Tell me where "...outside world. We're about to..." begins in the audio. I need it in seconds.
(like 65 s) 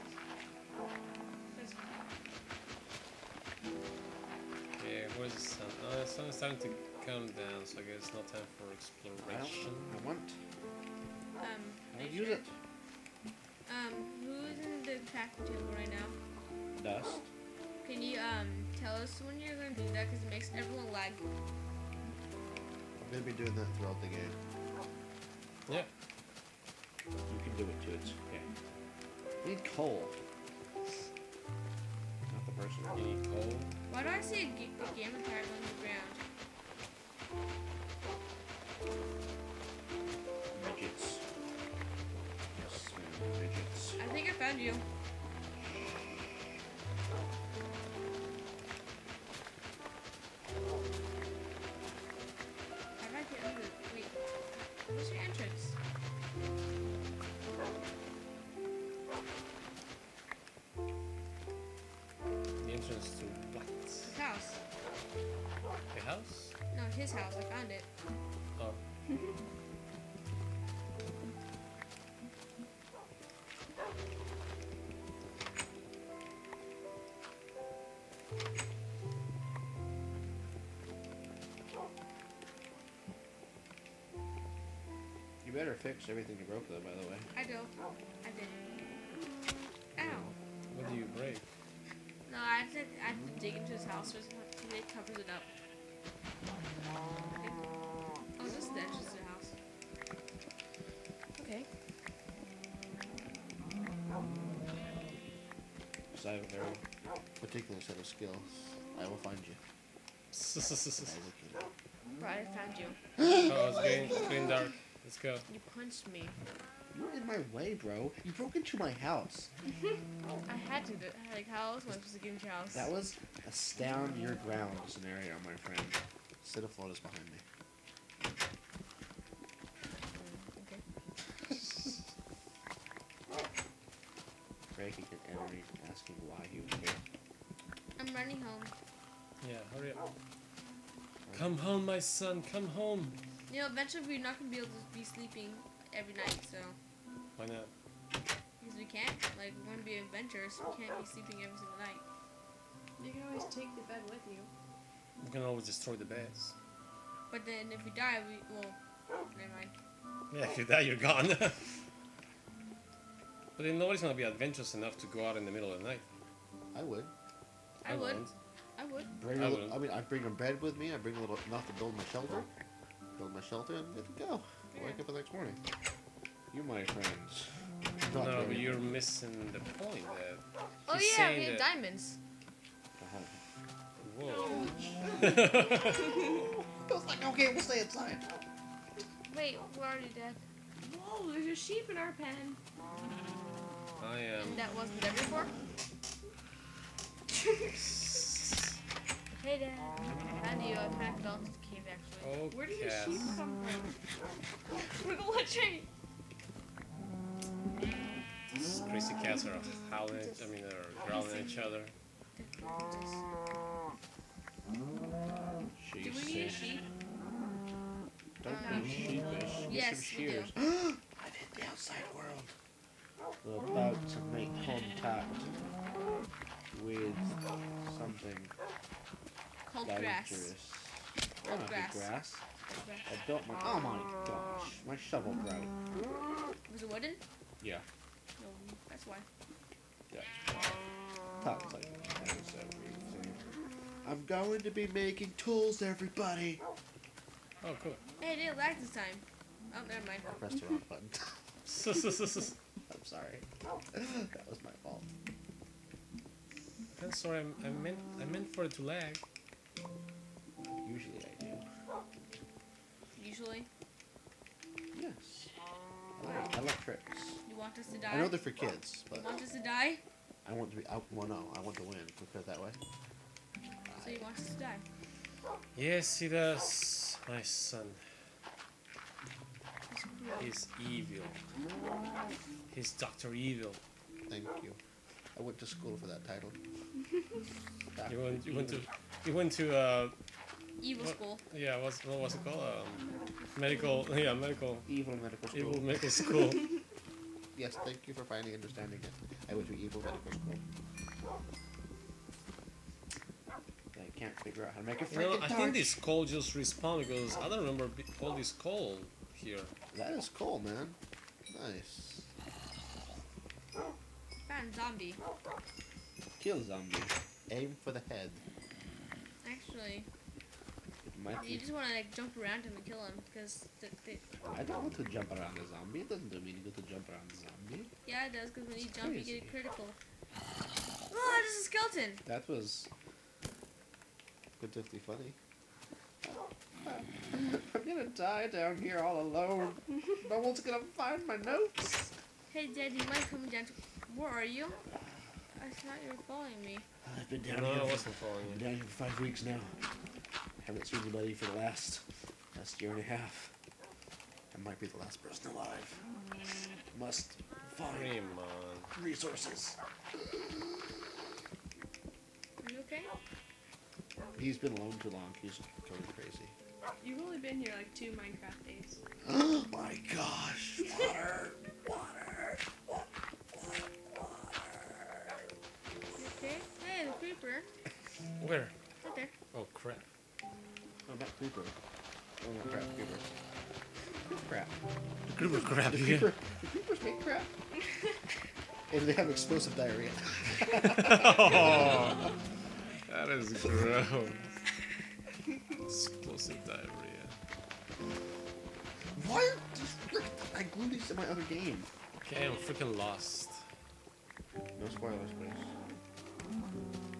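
221 s.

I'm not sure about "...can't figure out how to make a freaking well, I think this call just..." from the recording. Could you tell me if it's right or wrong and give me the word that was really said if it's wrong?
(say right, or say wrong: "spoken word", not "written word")
right.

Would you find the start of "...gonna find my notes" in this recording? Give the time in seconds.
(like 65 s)
340 s.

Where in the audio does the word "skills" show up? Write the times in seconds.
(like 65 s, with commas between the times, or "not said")
108 s.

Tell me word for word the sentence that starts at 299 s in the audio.
I would be evil medical school.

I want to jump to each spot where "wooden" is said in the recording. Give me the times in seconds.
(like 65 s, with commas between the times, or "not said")
236 s.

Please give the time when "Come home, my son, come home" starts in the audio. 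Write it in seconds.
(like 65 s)
141 s.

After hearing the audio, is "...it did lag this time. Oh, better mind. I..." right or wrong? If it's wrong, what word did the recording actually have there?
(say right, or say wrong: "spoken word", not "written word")
wrong: "never", not "better".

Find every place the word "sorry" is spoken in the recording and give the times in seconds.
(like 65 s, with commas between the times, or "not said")
253 s, 257 s.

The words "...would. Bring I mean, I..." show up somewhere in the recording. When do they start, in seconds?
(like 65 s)
168 s.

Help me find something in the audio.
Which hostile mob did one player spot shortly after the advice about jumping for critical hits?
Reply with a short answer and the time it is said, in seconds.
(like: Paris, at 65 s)
Skeleton, at 331 s.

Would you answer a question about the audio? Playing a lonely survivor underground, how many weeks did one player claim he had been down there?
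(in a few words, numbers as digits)
5.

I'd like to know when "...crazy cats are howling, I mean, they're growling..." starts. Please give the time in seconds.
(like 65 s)
208 s.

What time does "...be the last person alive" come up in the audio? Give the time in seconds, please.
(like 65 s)
354 s.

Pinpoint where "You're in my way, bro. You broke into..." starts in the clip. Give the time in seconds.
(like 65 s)
116 s.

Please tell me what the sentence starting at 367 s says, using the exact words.
You've only been here like two Minecraft days.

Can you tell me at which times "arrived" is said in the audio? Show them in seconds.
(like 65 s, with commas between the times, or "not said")
not said.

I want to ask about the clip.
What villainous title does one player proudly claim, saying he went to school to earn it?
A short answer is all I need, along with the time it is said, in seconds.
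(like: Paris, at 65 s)
Doctor Evil, at 282 s.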